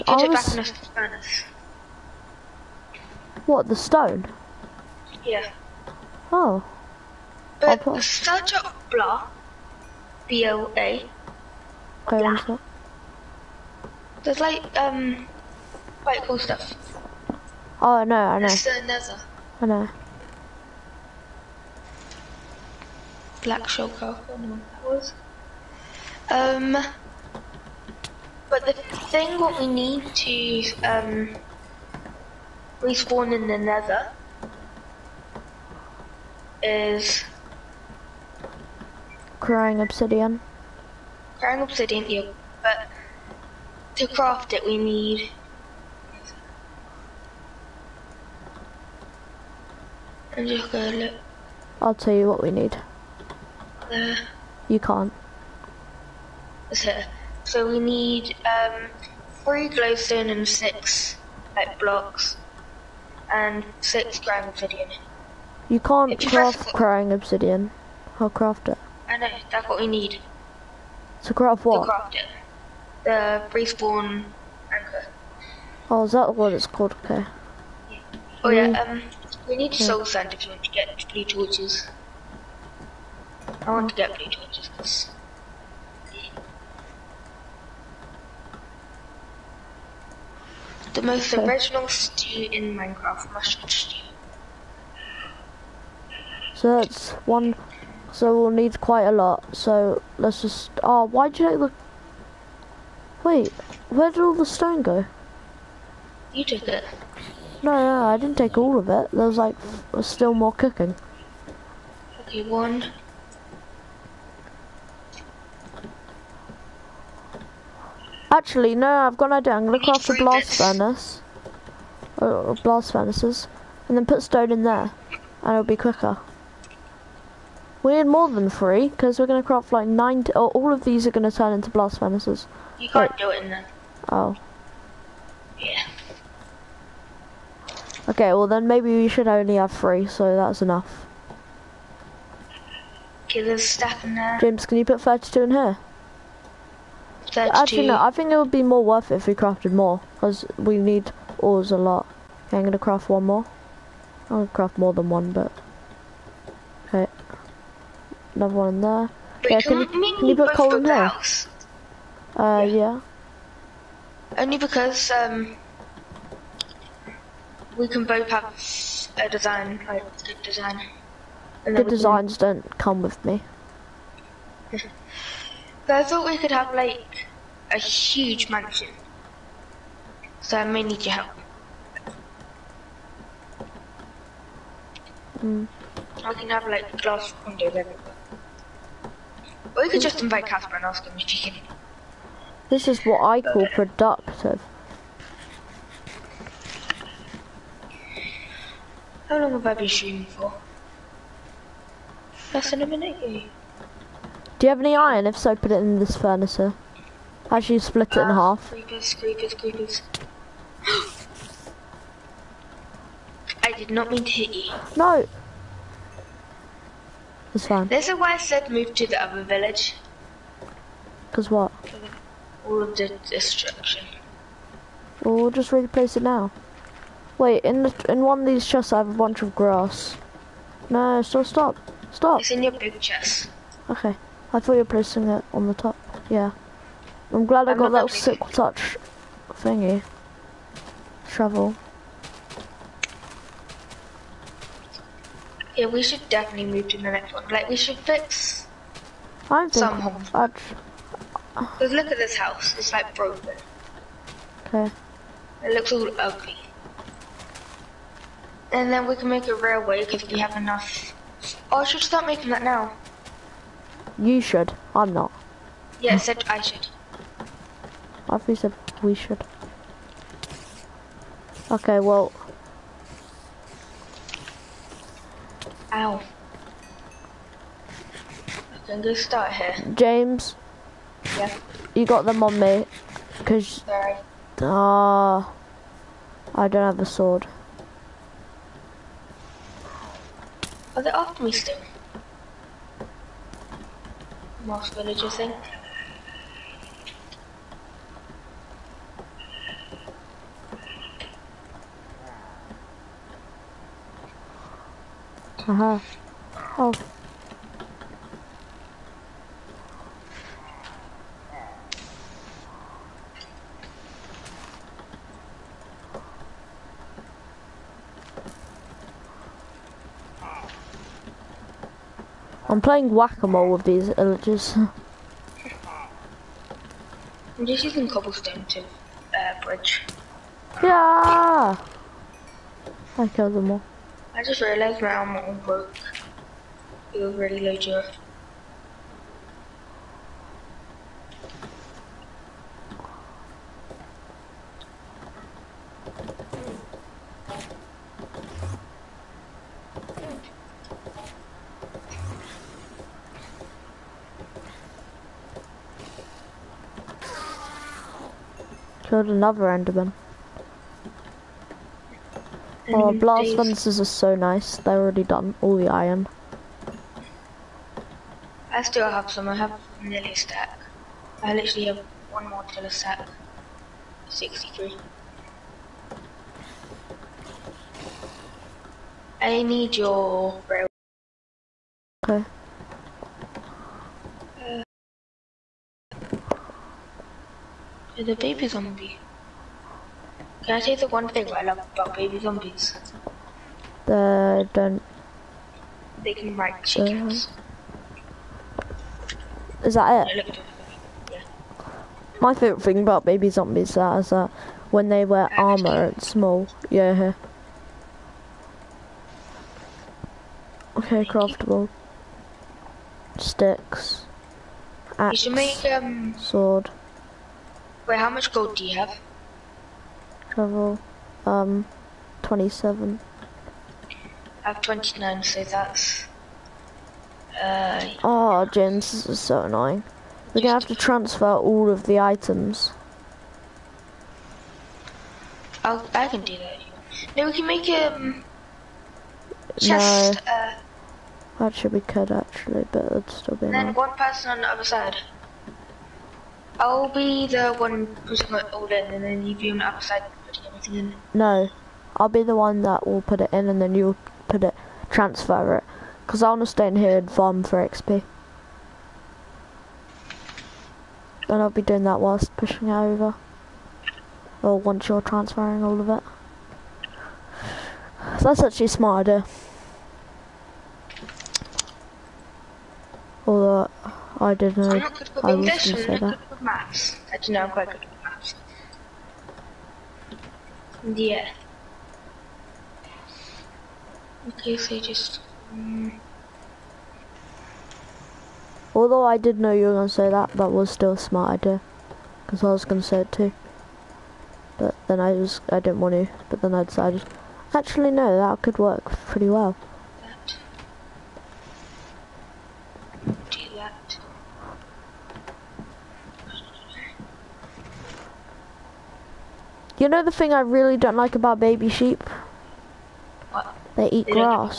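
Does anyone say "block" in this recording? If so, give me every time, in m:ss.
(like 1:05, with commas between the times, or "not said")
0:08, 1:01.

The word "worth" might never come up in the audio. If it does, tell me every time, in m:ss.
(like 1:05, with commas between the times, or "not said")
2:28.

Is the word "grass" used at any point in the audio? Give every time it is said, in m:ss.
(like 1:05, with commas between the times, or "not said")
3:49.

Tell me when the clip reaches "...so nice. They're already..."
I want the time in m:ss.
6:04.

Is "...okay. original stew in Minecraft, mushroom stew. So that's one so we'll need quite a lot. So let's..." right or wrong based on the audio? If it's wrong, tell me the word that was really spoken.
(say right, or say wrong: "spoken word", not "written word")
right.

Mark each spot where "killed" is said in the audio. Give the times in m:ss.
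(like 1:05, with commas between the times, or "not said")
5:33, 5:59.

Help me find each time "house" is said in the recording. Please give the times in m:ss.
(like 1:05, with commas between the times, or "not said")
2:41, 4:12.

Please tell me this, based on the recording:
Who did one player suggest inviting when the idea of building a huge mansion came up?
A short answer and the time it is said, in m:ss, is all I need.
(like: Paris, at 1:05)
Casper, at 3:10.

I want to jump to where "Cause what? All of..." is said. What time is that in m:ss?
3:41.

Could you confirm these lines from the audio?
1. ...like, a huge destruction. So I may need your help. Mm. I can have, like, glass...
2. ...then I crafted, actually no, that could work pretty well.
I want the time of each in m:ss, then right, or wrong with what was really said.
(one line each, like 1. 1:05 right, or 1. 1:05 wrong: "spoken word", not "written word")
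1. 2:56 wrong: "mansion", not "destruction"
2. 8:16 wrong: "decided", not "crafted".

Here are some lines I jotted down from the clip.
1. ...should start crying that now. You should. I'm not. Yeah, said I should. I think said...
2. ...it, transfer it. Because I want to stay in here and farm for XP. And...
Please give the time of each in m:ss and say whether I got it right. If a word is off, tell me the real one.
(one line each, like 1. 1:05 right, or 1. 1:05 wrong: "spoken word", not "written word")
1. 4:21 wrong: "making", not "crying"
2. 7:34 right.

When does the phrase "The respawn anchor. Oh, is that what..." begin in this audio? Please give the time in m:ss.
1:13.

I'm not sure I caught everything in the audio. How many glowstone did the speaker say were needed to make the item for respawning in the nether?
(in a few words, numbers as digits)
3.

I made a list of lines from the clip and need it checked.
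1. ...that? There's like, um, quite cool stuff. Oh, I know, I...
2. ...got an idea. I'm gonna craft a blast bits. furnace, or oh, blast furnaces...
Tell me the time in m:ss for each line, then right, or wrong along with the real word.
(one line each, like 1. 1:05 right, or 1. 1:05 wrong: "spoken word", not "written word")
1. 0:12 right
2. 1:59 right.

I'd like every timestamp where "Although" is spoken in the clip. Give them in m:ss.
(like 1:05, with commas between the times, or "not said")
7:53, 8:08.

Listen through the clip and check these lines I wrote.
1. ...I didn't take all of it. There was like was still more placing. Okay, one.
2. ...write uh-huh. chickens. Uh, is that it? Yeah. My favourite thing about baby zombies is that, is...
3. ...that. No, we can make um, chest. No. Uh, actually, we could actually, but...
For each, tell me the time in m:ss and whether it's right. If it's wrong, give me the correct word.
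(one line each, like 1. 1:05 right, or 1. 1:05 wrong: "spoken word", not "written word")
1. 1:48 wrong: "cooking", not "placing"
2. 6:36 right
3. 7:16 right.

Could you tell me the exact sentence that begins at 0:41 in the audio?
Crying obsidian, yeah, but to craft it we need...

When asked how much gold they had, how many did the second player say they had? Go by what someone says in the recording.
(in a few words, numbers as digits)
29.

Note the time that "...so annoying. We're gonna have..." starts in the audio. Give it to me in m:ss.
7:09.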